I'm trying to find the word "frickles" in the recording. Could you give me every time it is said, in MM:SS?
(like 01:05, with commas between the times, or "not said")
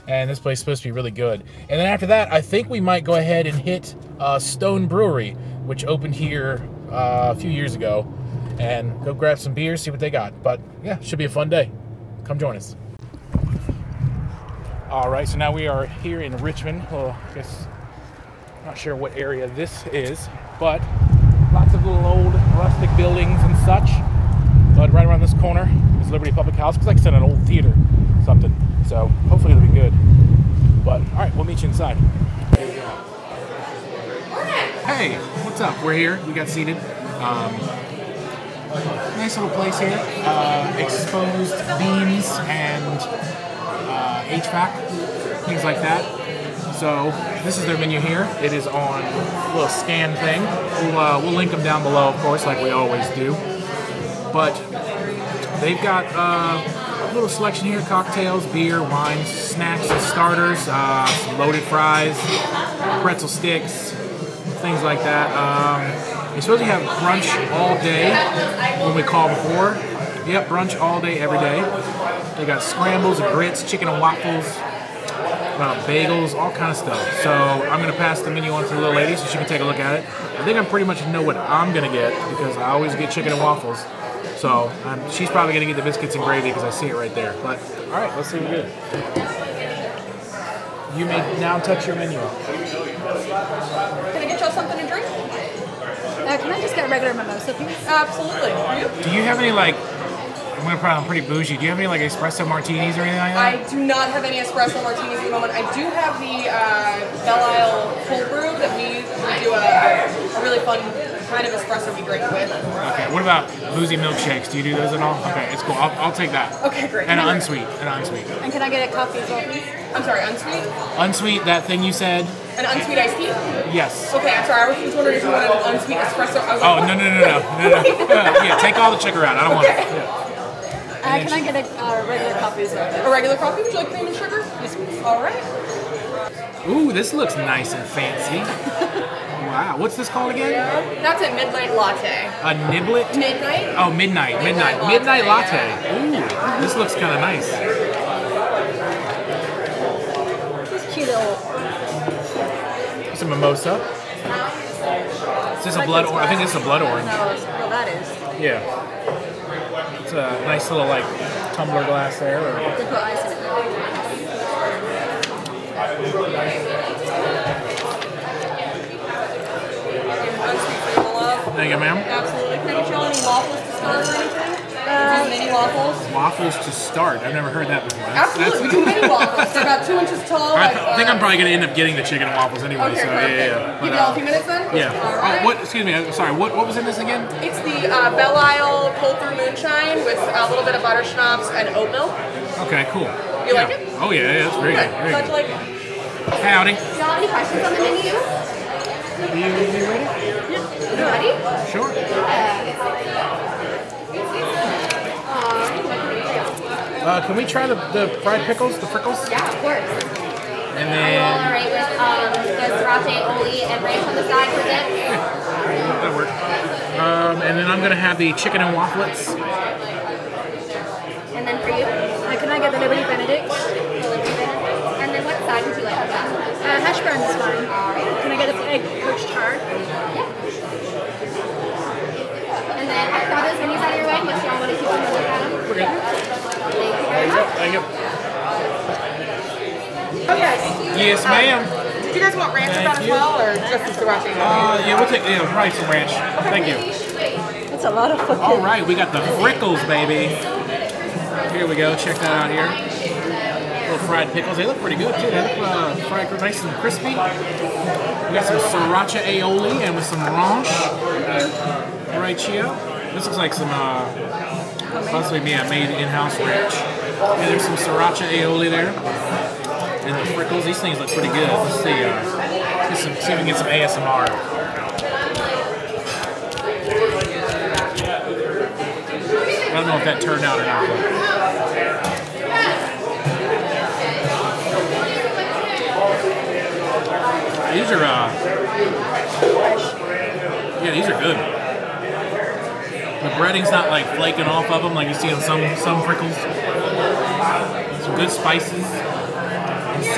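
03:28, 04:09, 04:30, 04:56.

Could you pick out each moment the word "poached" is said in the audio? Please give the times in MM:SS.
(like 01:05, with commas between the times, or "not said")
03:49.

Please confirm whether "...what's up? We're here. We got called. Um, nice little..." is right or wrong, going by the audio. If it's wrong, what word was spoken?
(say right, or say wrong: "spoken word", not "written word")
wrong: "seated", not "called".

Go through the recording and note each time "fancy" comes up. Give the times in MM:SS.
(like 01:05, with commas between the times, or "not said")
02:17.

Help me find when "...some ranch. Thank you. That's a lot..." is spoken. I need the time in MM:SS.
04:05.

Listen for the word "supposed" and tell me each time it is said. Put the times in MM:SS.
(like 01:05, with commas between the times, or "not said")
00:00, 01:06.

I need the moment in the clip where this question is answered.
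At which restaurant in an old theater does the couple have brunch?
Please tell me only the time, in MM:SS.
00:26.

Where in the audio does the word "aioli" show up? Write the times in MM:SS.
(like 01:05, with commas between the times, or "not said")
03:33, 04:19, 04:28.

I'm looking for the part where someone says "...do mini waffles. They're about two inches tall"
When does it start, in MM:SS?
02:58.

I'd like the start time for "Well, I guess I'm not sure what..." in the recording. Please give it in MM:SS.
00:16.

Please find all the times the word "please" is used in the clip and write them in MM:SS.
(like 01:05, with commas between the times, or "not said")
01:37, 01:59.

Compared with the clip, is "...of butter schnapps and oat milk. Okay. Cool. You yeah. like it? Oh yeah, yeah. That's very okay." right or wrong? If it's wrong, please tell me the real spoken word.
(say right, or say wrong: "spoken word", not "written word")
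right.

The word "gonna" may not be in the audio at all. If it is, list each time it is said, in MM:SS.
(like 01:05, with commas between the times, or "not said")
01:40, 03:37.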